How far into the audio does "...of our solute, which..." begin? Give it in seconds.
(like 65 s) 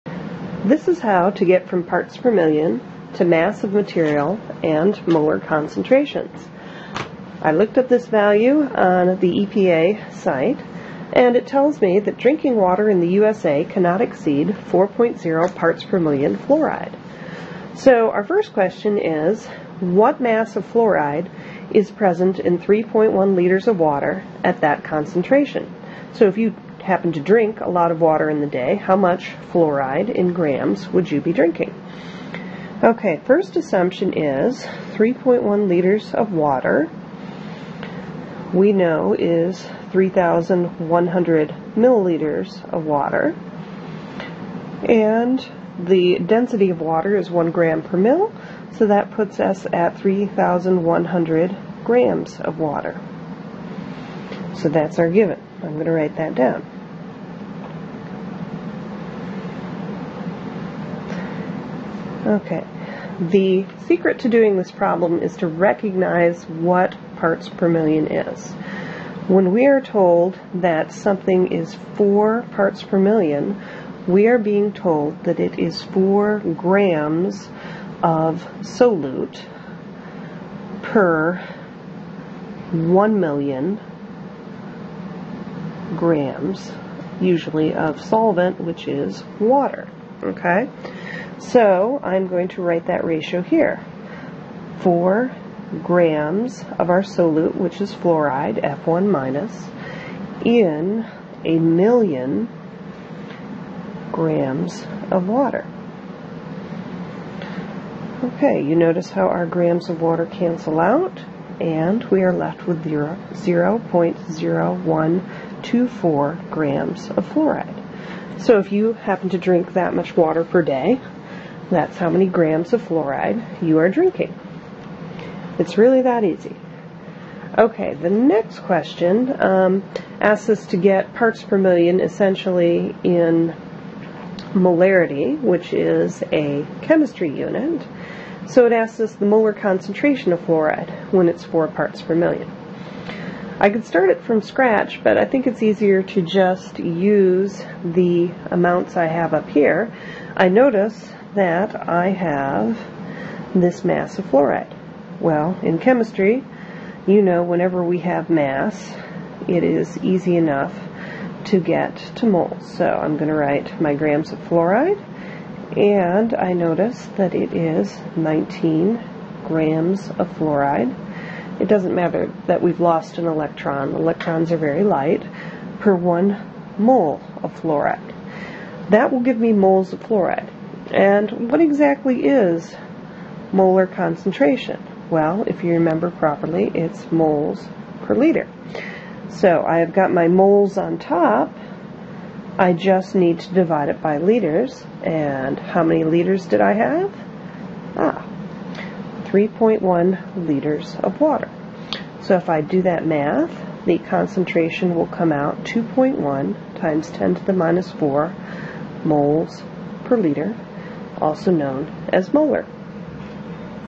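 96 s.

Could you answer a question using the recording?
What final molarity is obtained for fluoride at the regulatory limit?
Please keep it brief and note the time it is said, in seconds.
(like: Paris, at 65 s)
2.1 x 10^-4 M, at 205 s.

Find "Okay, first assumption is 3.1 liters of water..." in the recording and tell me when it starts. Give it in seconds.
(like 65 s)
32 s.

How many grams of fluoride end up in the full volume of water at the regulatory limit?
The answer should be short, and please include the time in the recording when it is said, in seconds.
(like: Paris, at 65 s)
0.0124 grams, at 113 s.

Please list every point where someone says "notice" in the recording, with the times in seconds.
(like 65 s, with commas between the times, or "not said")
108 s, 150 s, 166 s.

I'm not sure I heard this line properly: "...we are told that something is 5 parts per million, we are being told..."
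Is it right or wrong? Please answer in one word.
wrong.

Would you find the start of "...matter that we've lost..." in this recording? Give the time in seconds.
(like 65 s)
171 s.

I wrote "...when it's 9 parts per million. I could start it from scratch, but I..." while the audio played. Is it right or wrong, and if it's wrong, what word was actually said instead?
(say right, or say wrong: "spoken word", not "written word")
wrong: "4", not "9".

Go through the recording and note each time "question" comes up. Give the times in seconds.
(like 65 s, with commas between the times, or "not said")
18 s, 128 s.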